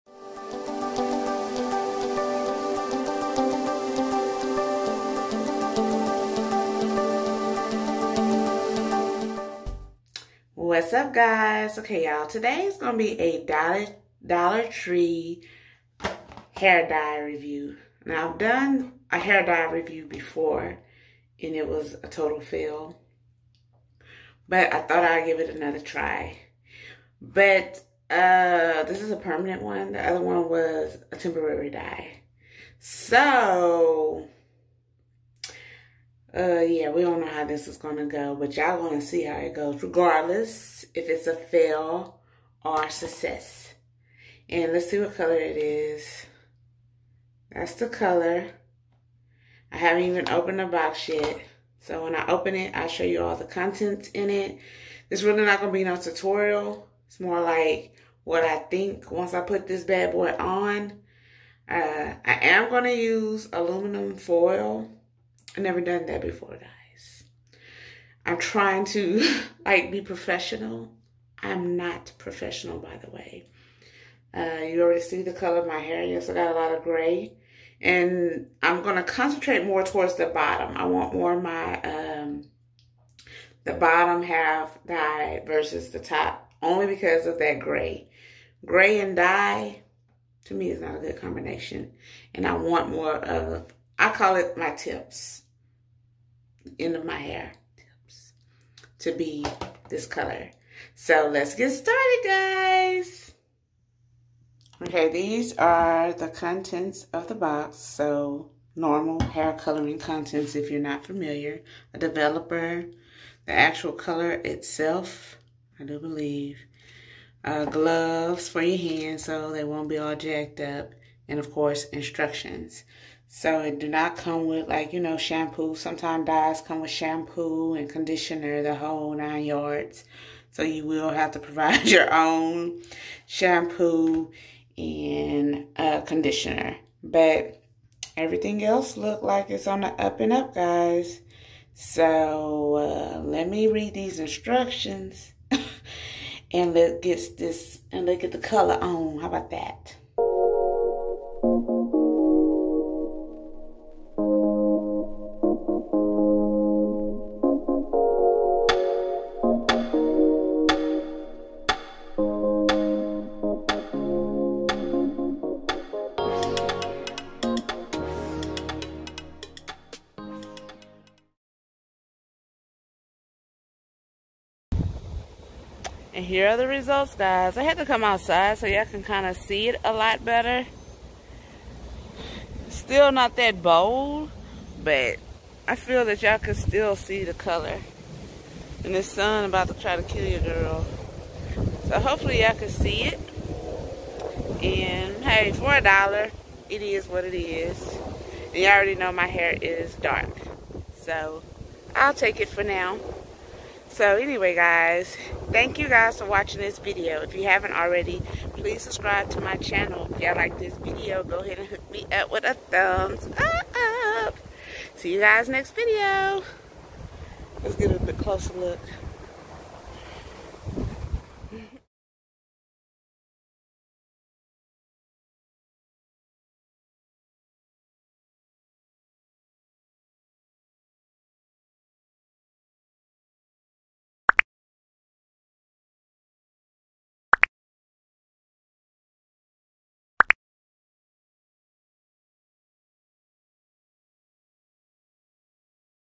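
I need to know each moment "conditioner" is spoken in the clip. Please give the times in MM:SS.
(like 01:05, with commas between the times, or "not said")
02:07, 02:16.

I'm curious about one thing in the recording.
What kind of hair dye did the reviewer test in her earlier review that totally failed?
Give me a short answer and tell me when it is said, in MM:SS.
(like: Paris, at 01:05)
temporary, at 00:31.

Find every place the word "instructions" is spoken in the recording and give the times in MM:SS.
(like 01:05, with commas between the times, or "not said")
02:01, 02:24.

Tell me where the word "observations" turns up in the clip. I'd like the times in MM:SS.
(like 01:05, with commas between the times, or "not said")
not said.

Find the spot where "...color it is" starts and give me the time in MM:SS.
00:45.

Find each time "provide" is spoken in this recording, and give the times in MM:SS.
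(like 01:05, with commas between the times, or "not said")
02:11.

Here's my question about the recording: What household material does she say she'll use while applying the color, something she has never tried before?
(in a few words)
aluminum foil.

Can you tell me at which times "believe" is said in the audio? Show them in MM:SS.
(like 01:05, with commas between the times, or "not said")
01:55.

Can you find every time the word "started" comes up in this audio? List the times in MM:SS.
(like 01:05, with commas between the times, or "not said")
01:41.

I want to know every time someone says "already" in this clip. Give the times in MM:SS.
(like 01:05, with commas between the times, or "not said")
01:14, 03:18, 03:27.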